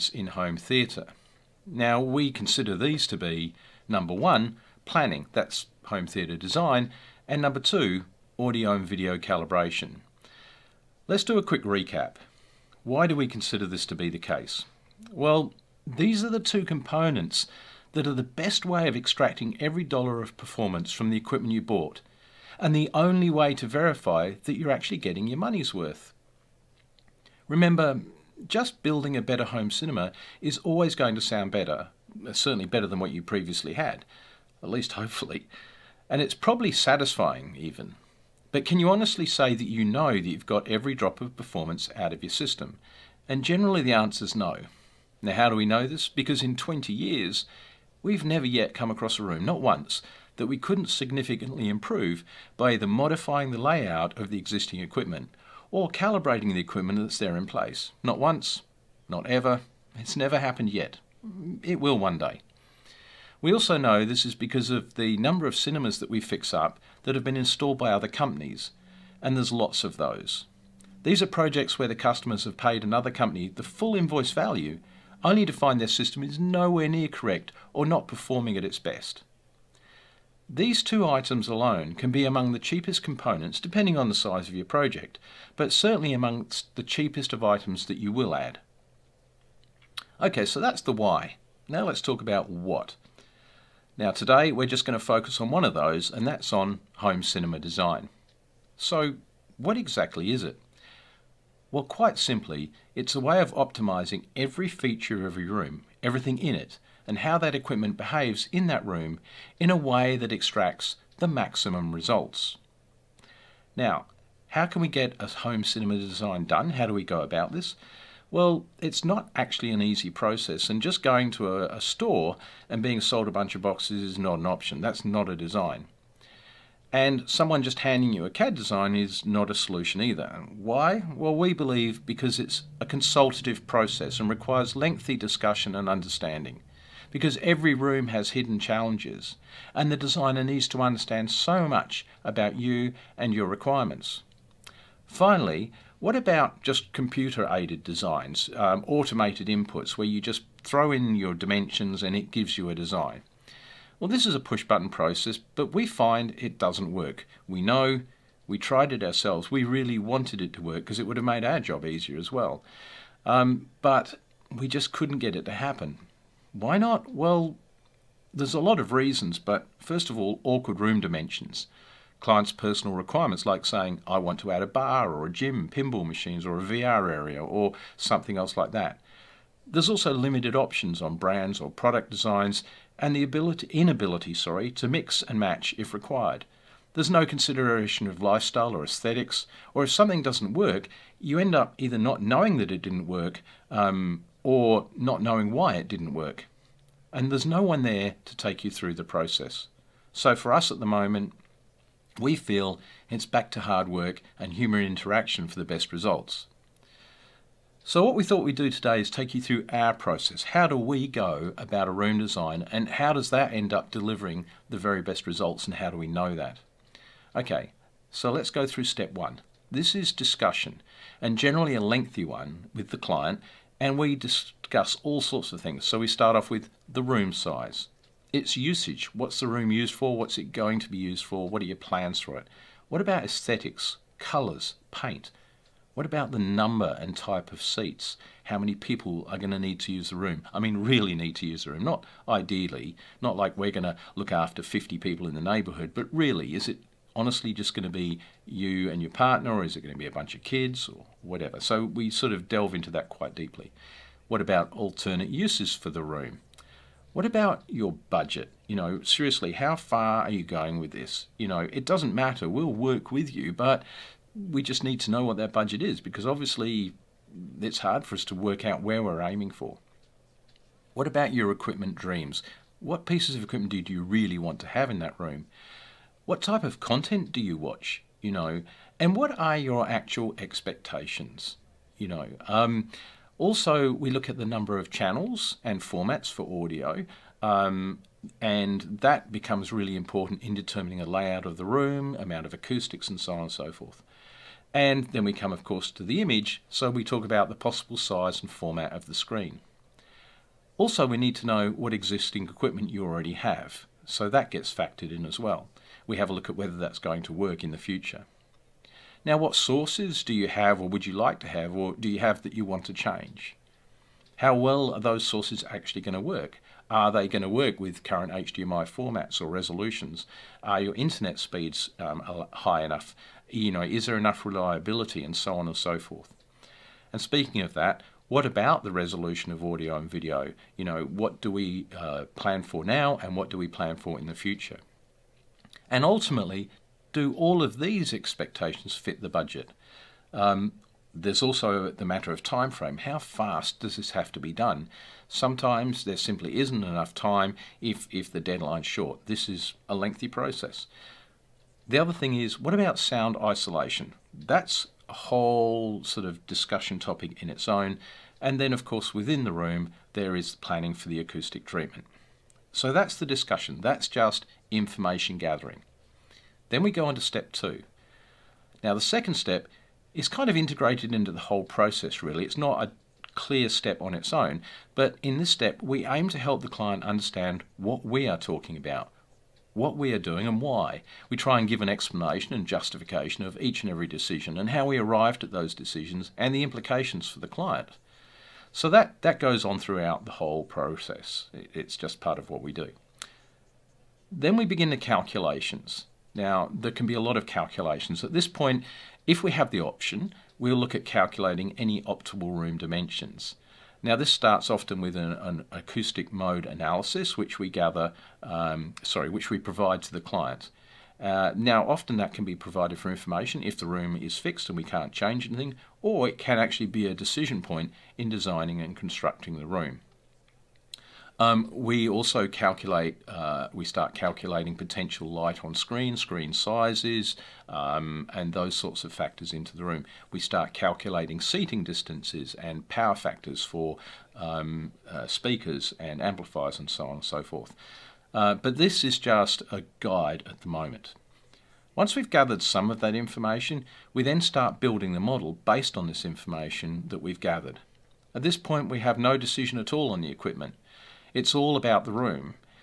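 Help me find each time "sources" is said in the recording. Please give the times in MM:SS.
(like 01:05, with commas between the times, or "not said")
05:09, 05:15.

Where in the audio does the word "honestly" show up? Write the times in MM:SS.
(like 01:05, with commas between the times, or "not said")
00:38, 04:07.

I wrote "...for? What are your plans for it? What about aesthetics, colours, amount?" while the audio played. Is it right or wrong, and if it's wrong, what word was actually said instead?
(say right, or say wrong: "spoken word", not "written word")
wrong: "paint", not "amount".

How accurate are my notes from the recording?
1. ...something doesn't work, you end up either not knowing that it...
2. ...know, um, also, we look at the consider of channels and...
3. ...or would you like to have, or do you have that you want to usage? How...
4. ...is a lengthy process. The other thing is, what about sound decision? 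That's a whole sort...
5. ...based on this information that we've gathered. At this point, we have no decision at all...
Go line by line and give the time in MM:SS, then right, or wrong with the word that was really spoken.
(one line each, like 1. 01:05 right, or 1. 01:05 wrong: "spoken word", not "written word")
1. 03:09 right
2. 04:42 wrong: "number", not "consider"
3. 05:10 wrong: "change", not "usage"
4. 05:49 wrong: "isolation", not "decision"
5. 07:25 right.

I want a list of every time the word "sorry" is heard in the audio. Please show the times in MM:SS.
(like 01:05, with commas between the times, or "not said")
03:04, 06:49.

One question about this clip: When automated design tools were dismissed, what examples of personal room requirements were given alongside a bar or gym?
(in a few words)
Pinball machines.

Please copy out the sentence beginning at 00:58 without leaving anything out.
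Not once, not ever, it's never happened yet.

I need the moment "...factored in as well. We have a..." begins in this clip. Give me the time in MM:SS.
05:04.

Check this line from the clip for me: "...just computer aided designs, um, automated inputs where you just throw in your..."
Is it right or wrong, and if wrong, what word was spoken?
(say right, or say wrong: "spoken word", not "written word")
right.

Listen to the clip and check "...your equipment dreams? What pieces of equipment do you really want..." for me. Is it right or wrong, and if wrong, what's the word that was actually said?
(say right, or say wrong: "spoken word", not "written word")
right.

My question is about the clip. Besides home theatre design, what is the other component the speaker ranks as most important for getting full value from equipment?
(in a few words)
Audio and video calibration.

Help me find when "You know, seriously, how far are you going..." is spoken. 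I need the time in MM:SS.
04:18.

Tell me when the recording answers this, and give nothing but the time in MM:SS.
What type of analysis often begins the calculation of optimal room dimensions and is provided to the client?
06:45.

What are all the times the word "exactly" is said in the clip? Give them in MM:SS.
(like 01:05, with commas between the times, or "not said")
01:39.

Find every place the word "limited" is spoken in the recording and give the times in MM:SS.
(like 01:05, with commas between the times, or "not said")
03:00.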